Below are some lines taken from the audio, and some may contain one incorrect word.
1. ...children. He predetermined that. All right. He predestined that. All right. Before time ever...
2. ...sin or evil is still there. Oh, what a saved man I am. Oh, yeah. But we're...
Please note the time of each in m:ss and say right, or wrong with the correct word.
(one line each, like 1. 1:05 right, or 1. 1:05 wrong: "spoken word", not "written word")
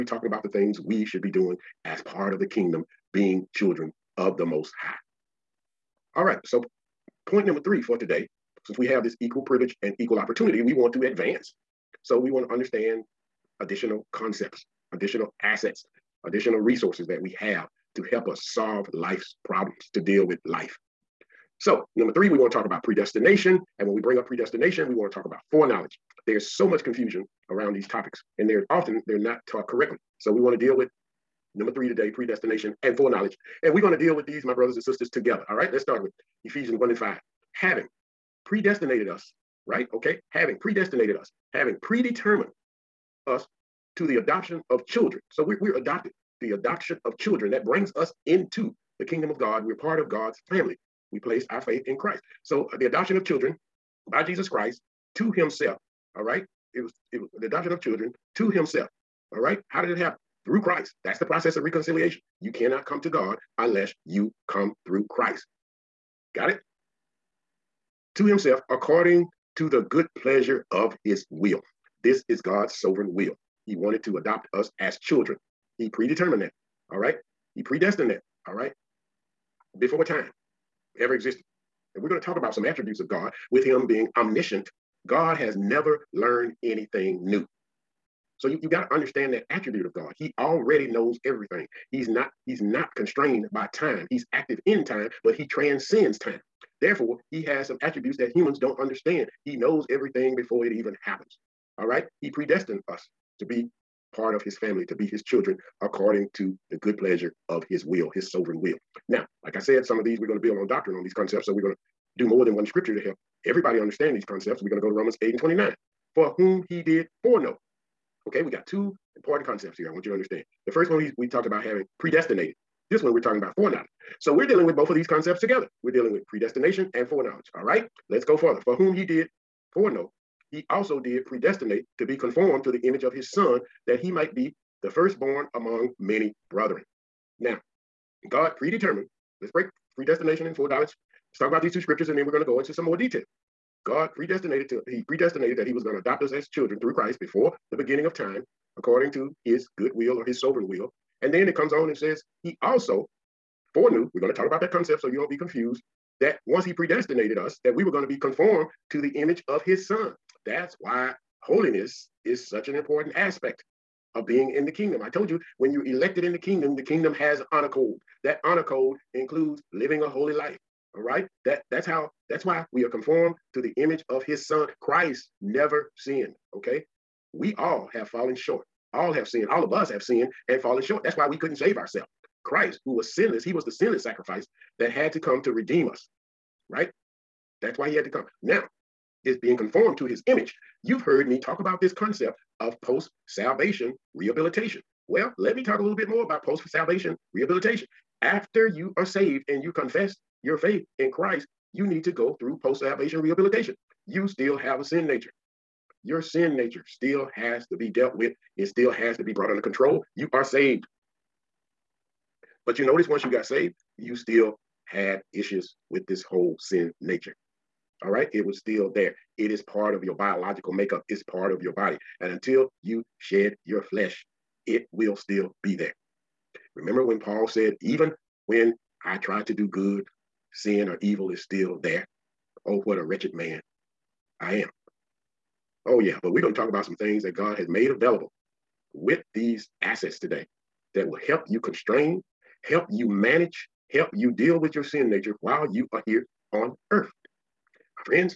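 1. 1:15 right
2. 3:50 wrong: "wretched", not "saved".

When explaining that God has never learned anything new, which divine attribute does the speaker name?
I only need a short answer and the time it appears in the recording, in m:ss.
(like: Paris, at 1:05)
Omniscient, at 1:24.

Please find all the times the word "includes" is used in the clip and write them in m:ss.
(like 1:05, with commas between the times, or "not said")
2:49.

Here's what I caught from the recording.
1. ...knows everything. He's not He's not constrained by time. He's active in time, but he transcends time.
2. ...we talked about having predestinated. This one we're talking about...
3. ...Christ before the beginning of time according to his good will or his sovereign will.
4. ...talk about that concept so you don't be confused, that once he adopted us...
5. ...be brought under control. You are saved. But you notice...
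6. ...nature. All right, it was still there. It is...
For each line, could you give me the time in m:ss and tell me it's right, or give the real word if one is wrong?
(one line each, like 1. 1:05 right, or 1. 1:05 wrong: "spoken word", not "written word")
1. 1:30 right
2. 2:01 right
3. 2:26 right
4. 2:34 wrong: "predestinated", not "adopted"
5. 3:29 right
6. 3:37 right.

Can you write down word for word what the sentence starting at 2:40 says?
That's why holiness is such an important aspect of being in the kingdom.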